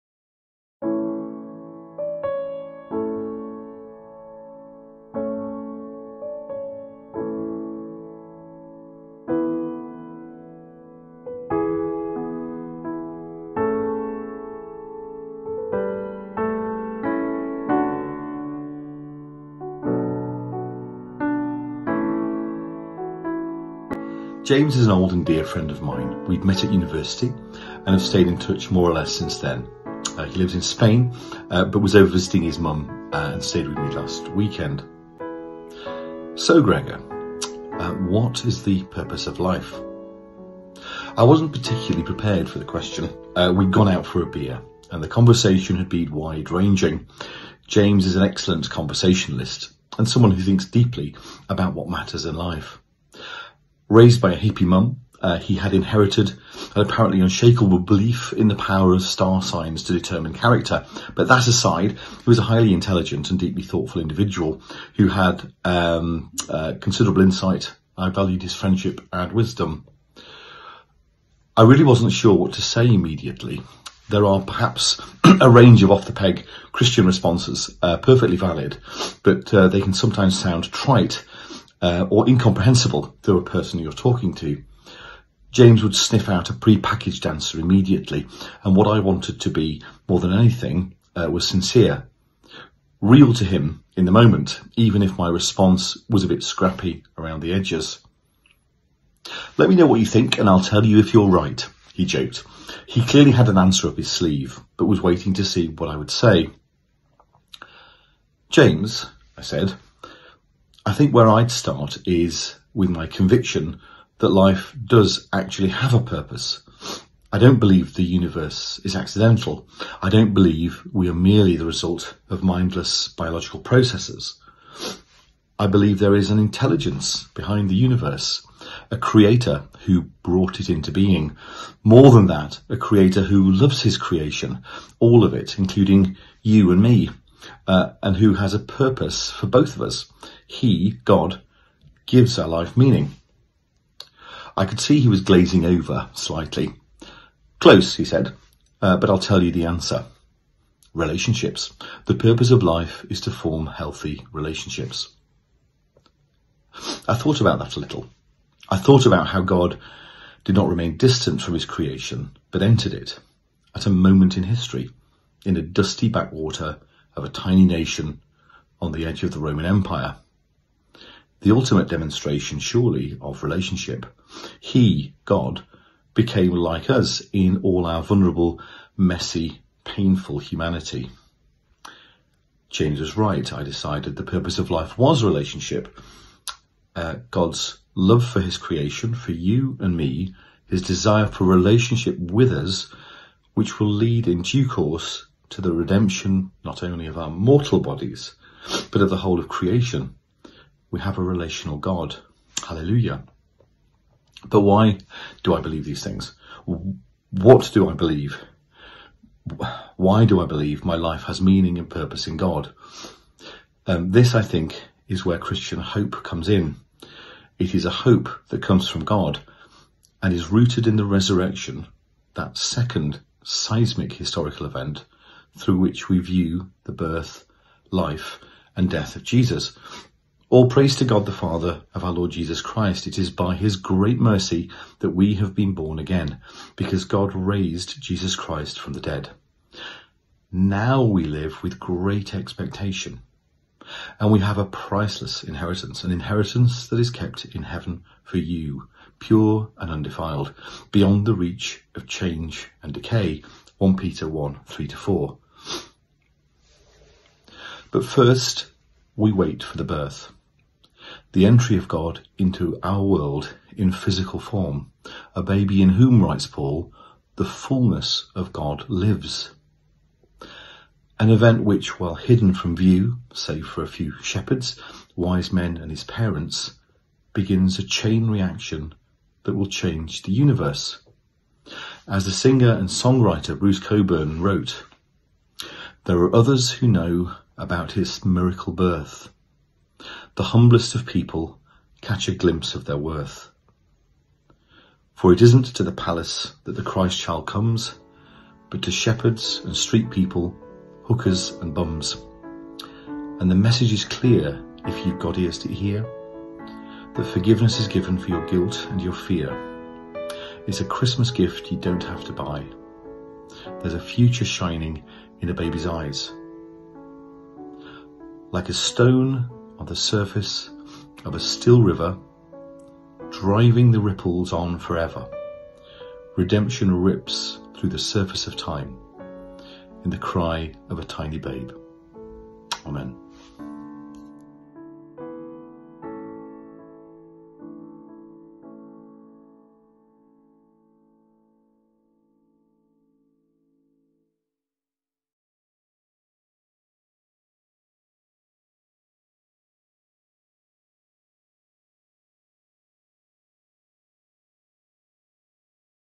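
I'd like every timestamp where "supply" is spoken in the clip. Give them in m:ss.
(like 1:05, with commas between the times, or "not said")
not said.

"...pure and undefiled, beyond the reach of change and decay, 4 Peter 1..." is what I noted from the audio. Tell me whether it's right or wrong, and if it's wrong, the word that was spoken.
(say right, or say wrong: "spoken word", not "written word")
wrong: "1", not "4".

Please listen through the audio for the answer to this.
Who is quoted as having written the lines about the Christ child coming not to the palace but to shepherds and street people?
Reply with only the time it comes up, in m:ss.
4:43.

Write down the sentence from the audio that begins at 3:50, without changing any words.
All praise to God the Father of our Lord Jesus Christ.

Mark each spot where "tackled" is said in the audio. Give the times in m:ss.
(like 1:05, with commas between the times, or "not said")
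not said.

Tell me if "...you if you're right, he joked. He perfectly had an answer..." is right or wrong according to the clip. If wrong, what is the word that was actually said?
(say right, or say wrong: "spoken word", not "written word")
wrong: "clearly", not "perfectly".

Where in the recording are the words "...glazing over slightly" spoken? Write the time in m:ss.
2:25.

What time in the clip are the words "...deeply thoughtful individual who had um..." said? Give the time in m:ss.
1:03.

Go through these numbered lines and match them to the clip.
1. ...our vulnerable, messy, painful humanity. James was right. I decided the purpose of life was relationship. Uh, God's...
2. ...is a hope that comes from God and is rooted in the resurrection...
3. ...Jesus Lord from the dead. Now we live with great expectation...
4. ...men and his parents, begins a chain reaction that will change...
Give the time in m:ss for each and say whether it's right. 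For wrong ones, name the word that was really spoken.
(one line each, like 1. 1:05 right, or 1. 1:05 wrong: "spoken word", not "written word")
1. 2:57 right
2. 3:37 right
3. 3:58 wrong: "Christ", not "Lord"
4. 4:35 right.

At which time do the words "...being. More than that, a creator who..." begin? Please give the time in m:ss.
2:10.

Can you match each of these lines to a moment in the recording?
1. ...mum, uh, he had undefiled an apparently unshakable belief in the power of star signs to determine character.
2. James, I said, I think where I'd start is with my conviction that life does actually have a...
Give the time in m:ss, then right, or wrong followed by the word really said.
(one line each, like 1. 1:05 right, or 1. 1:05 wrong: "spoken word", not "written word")
1. 0:54 wrong: "inherited", not "undefiled"
2. 1:48 right.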